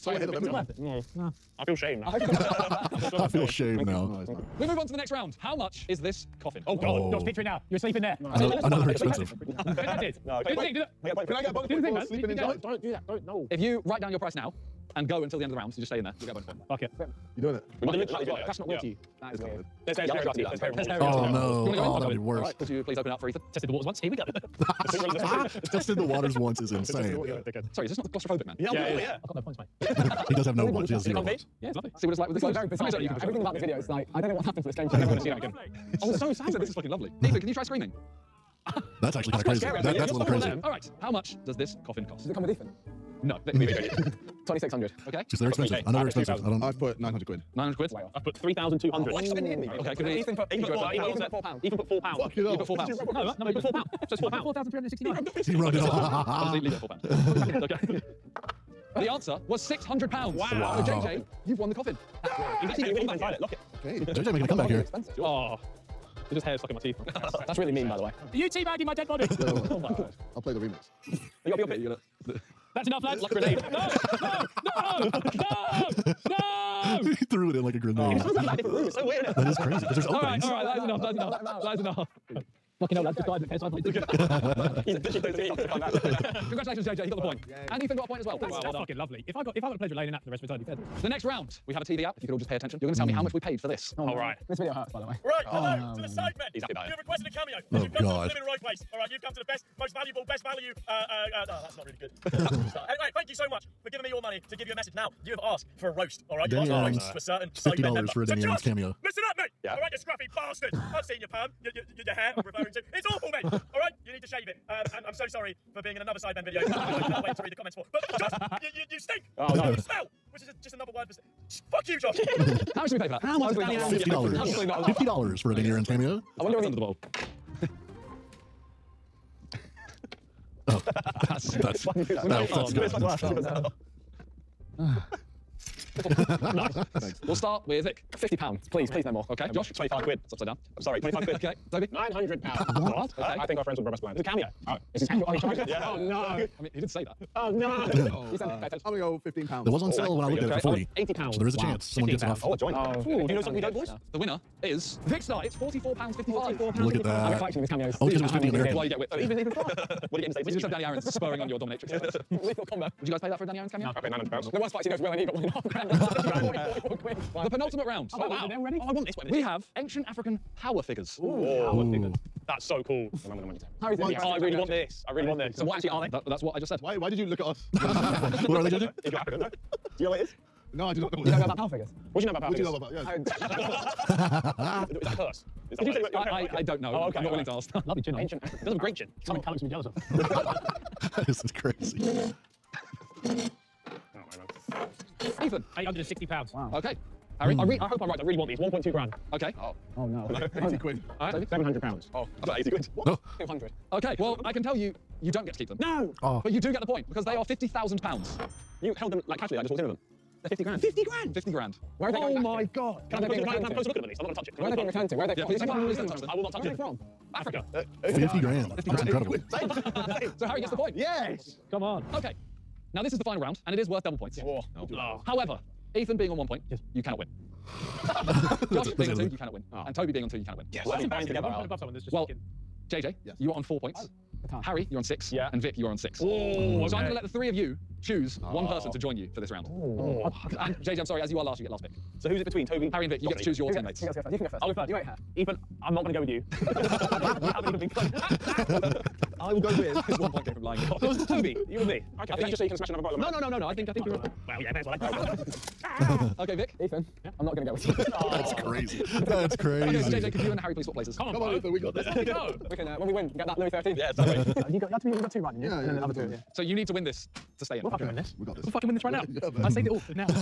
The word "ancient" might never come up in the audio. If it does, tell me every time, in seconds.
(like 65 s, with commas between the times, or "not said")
169 s, 188 s.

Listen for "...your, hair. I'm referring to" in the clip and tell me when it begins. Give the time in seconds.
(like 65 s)
112 s.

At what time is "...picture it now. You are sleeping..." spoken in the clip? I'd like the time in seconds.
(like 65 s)
7 s.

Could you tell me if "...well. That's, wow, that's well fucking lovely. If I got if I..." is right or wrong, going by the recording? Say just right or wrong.
right.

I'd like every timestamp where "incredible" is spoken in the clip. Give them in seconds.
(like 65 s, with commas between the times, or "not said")
219 s.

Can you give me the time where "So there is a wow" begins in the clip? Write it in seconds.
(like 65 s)
151 s.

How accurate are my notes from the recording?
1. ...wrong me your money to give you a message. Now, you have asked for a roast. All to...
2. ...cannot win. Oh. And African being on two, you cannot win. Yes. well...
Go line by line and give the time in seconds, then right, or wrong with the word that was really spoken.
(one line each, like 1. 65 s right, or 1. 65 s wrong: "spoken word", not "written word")
1. 103 s wrong: "giving", not "wrong"
2. 229 s wrong: "Toby", not "African".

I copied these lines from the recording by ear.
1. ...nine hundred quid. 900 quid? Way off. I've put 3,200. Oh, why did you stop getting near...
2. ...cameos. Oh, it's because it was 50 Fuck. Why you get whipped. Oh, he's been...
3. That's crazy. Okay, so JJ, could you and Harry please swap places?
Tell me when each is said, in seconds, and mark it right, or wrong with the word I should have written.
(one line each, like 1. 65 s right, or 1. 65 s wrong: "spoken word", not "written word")
1. 46 s right
2. 157 s wrong: "American", not "Fuck"
3. 259 s right.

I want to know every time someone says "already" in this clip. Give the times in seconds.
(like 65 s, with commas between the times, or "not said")
168 s.